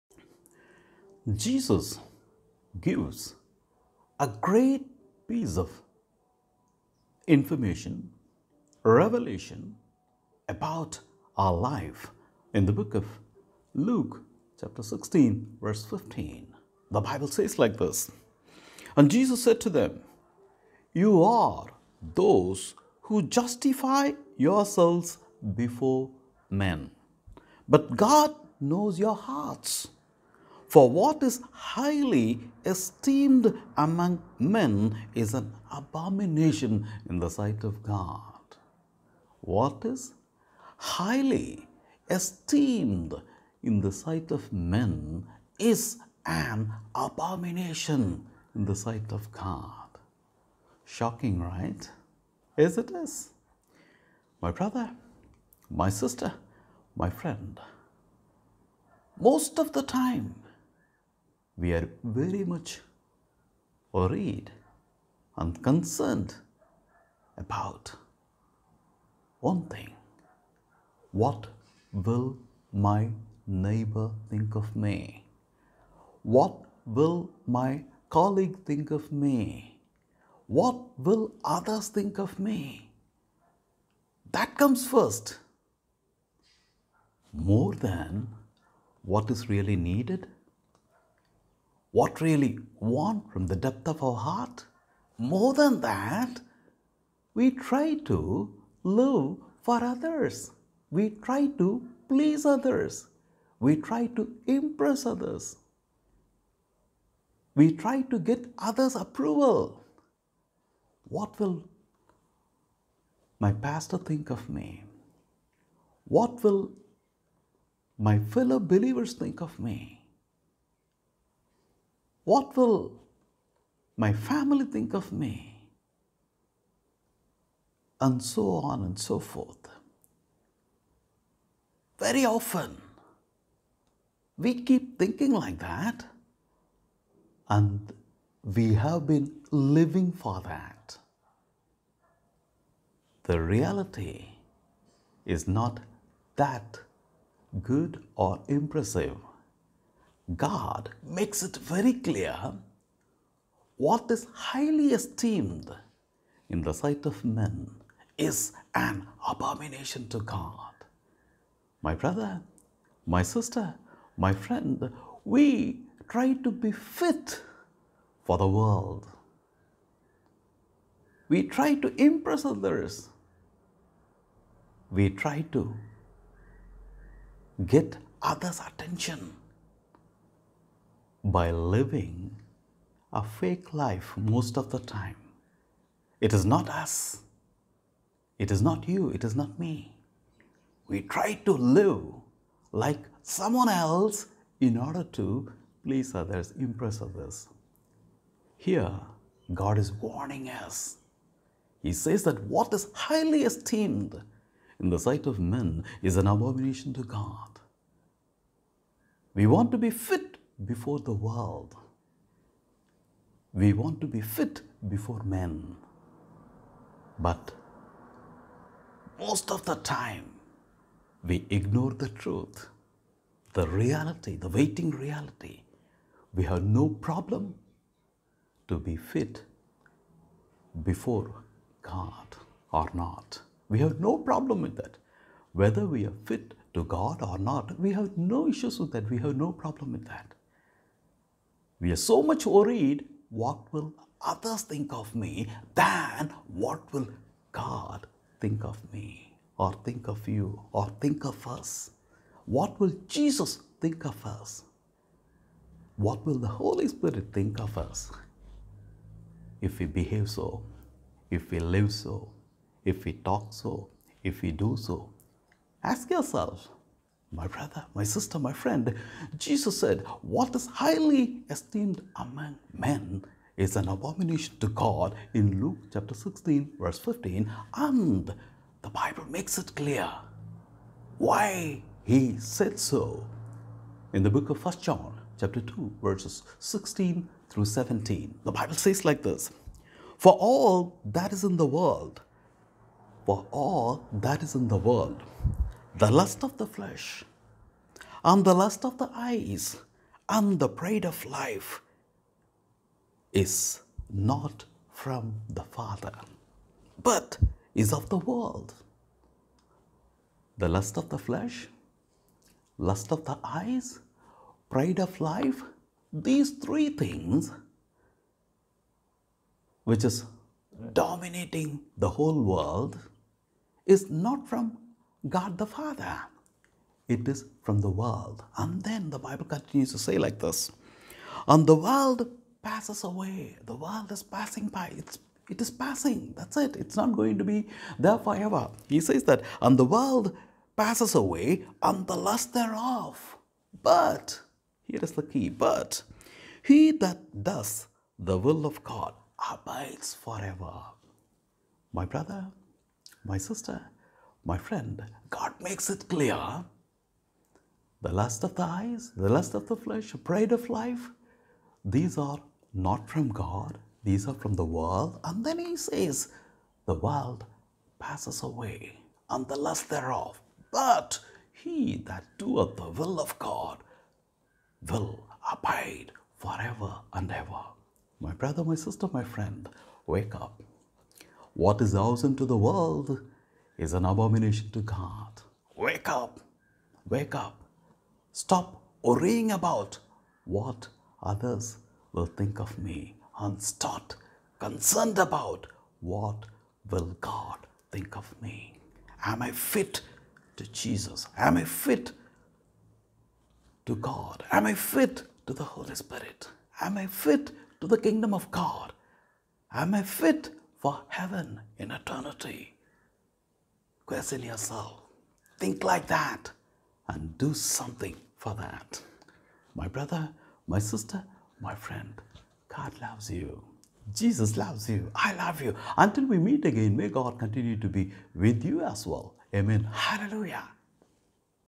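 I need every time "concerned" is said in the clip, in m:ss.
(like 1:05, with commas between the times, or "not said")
1:05, 6:34.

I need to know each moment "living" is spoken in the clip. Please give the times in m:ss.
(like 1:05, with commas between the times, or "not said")
2:19, 3:01.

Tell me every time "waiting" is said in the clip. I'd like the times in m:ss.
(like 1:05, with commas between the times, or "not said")
3:44.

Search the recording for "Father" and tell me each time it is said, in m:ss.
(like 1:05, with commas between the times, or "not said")
5:05, 5:25.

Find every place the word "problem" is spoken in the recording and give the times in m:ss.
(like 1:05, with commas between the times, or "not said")
3:46, 3:54, 3:59.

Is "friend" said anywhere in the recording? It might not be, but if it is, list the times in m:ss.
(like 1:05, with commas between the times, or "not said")
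0:57, 2:44, 4:28, 5:54, 6:19, 7:01.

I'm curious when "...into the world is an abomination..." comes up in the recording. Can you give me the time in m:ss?
6:22.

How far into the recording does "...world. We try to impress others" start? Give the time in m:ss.
2:48.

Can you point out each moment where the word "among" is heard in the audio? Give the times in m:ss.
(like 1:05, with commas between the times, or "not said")
0:33, 4:32.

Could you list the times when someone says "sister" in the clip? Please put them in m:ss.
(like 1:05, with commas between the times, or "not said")
0:55, 2:43, 4:28, 5:53, 6:18, 7:00.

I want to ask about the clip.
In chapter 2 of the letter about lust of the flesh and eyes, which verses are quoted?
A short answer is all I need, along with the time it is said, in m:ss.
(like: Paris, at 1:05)
16 to 17, at 4:46.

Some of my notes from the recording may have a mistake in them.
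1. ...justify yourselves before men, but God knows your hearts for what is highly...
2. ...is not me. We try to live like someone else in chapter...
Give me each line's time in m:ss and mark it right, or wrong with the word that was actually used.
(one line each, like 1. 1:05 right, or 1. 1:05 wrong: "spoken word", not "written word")
1. 0:23 right
2. 3:09 wrong: "order", not "chapter".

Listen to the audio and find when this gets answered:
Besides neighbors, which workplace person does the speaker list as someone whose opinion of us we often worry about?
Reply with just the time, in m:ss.
1:18.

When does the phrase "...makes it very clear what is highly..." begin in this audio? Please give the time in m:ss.
2:31.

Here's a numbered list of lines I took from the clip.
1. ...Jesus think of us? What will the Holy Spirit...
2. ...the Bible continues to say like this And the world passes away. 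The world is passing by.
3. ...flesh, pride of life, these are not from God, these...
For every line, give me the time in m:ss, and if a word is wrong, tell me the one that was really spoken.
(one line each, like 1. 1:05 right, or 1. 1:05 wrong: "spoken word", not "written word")
1. 4:13 right
2. 5:29 right
3. 5:59 right.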